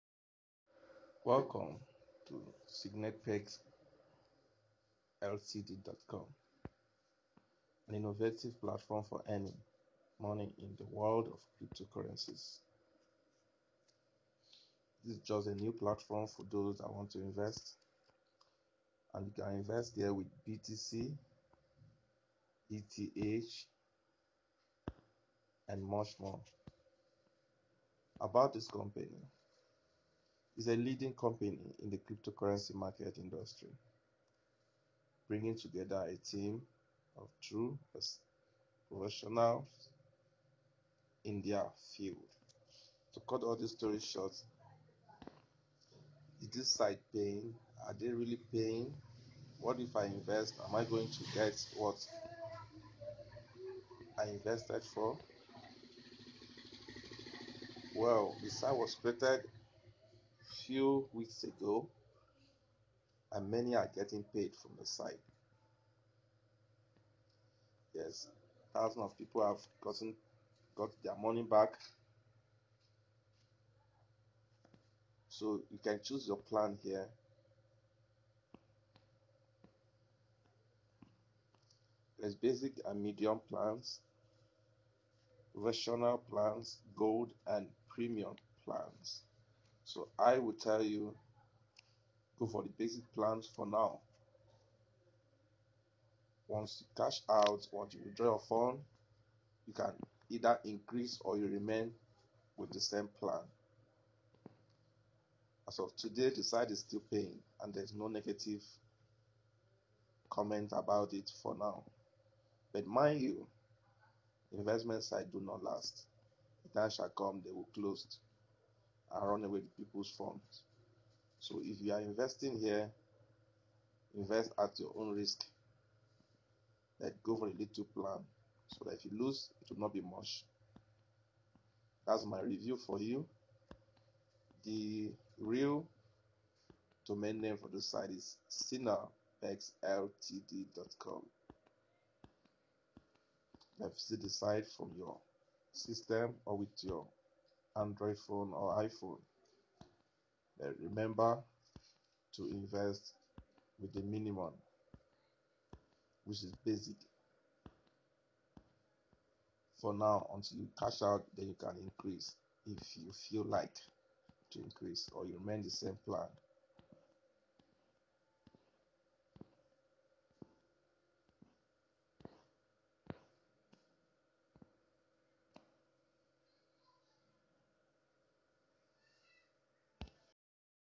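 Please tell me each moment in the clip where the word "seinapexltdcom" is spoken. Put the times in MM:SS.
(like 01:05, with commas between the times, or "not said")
00:03, 02:18.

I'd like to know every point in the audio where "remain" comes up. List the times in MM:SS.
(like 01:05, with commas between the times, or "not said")
01:41, 02:45.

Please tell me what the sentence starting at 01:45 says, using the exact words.
As of today, the site is still paying and there's no negative comment about it for now.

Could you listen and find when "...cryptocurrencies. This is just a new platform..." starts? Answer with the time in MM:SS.
00:11.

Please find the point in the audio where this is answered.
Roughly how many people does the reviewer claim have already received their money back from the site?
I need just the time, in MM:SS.
01:08.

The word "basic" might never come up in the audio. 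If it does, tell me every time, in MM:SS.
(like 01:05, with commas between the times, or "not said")
01:22, 01:32, 02:36.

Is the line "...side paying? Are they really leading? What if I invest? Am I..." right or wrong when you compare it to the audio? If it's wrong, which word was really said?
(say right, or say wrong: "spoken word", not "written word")
wrong: "paying", not "leading".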